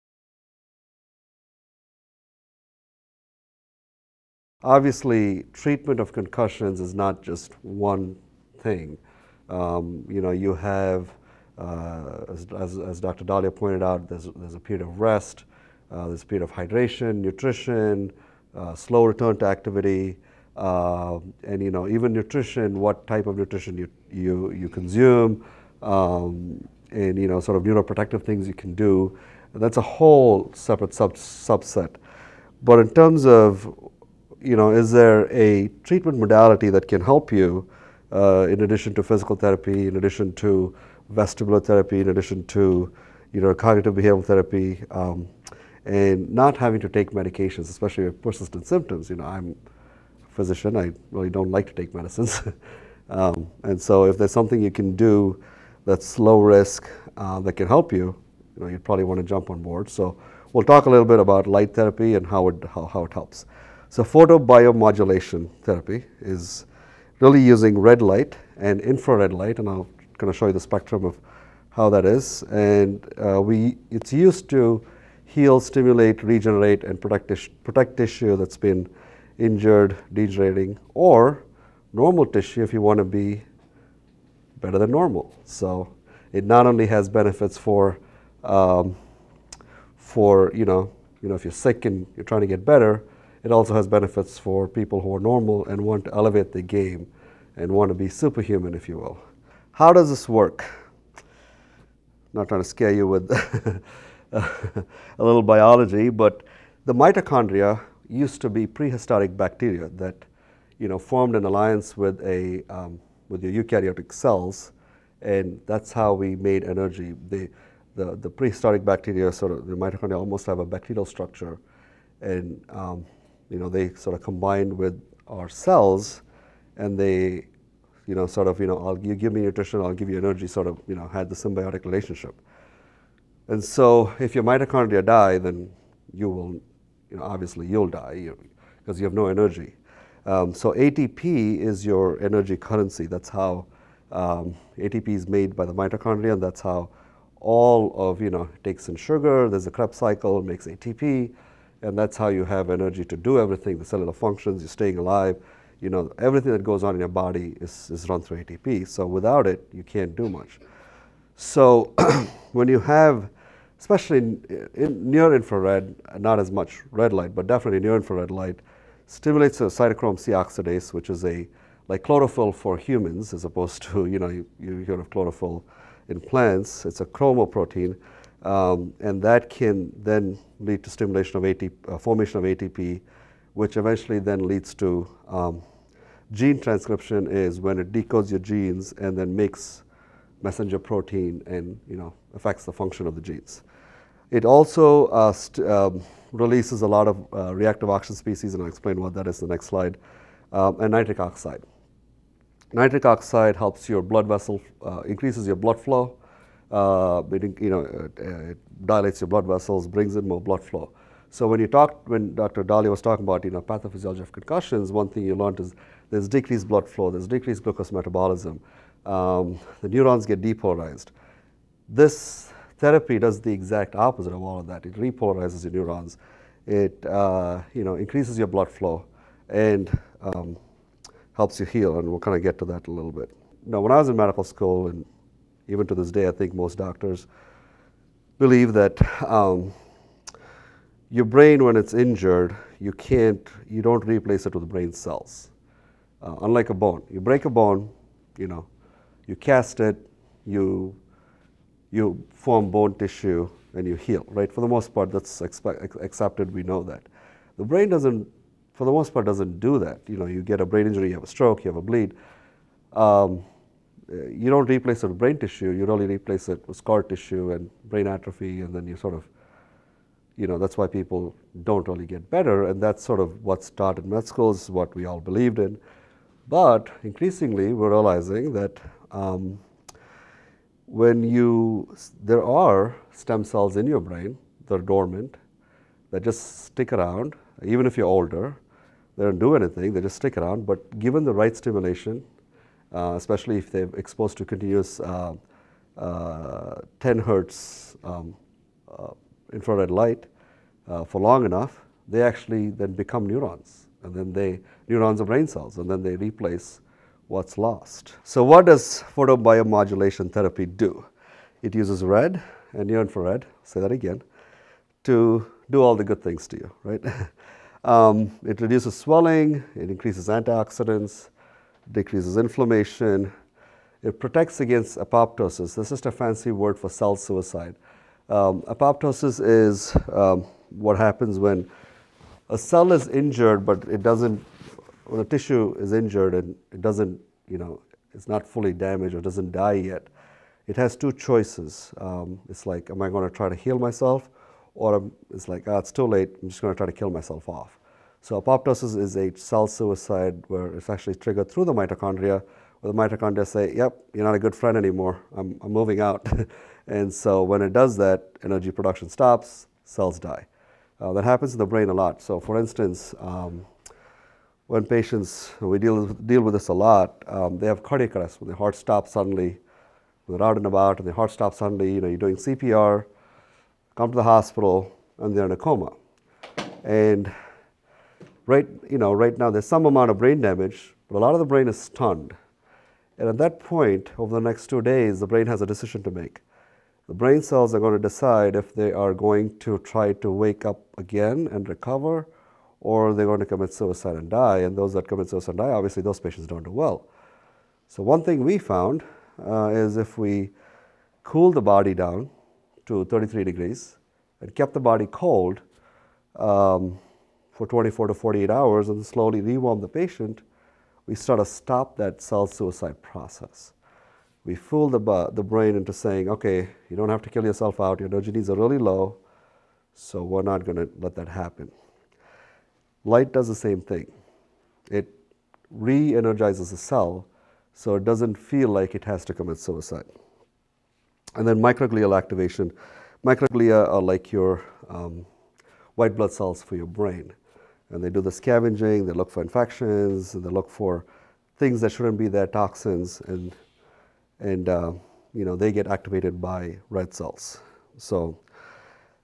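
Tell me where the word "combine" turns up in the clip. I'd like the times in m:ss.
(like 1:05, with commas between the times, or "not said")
2:04.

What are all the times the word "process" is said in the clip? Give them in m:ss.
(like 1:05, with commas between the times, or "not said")
6:52.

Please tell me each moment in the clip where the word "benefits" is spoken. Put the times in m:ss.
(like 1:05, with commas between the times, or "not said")
1:27, 1:33.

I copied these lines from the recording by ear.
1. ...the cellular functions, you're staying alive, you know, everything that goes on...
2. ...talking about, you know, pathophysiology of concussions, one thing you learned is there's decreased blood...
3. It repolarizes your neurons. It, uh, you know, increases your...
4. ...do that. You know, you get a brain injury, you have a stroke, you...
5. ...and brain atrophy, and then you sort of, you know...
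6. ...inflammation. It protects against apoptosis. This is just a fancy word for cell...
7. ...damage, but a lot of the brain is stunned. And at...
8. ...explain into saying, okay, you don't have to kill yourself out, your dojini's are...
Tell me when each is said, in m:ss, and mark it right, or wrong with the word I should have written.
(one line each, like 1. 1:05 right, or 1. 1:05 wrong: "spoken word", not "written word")
1. 2:33 right
2. 3:33 right
3. 3:44 right
4. 4:19 right
5. 4:27 right
6. 5:22 right
7. 6:20 right
8. 6:55 wrong: "brain", not "explain".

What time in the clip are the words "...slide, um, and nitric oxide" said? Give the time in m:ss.
3:19.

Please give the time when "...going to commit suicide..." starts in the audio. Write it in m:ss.
6:33.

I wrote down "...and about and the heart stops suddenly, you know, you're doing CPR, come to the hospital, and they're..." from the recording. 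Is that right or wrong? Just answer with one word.
right.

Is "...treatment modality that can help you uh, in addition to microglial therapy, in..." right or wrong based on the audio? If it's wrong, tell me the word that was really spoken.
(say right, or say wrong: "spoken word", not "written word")
wrong: "physical", not "microglial".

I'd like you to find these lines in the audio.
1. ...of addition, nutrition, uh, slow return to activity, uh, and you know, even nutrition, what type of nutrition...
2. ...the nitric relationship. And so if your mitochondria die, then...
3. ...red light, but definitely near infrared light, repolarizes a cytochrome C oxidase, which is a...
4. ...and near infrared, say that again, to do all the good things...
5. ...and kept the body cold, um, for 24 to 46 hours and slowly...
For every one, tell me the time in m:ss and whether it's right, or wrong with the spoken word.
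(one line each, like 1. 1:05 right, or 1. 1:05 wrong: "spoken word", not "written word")
1. 0:16 wrong: "hydration", not "addition"
2. 2:11 wrong: "symbiotic", not "nitric"
3. 2:46 wrong: "stimulates", not "repolarizes"
4. 5:12 right
5. 6:44 wrong: "48", not "46".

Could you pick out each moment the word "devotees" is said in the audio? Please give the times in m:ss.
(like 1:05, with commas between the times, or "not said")
not said.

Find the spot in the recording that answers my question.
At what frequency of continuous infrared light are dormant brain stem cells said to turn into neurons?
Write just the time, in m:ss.
4:56.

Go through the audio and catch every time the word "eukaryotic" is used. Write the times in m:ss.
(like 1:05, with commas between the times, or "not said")
1:53.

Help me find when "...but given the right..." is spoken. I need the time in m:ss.
4:50.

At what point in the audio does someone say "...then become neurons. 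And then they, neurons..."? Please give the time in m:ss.
5:02.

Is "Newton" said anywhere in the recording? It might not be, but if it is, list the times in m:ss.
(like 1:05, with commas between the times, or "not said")
not said.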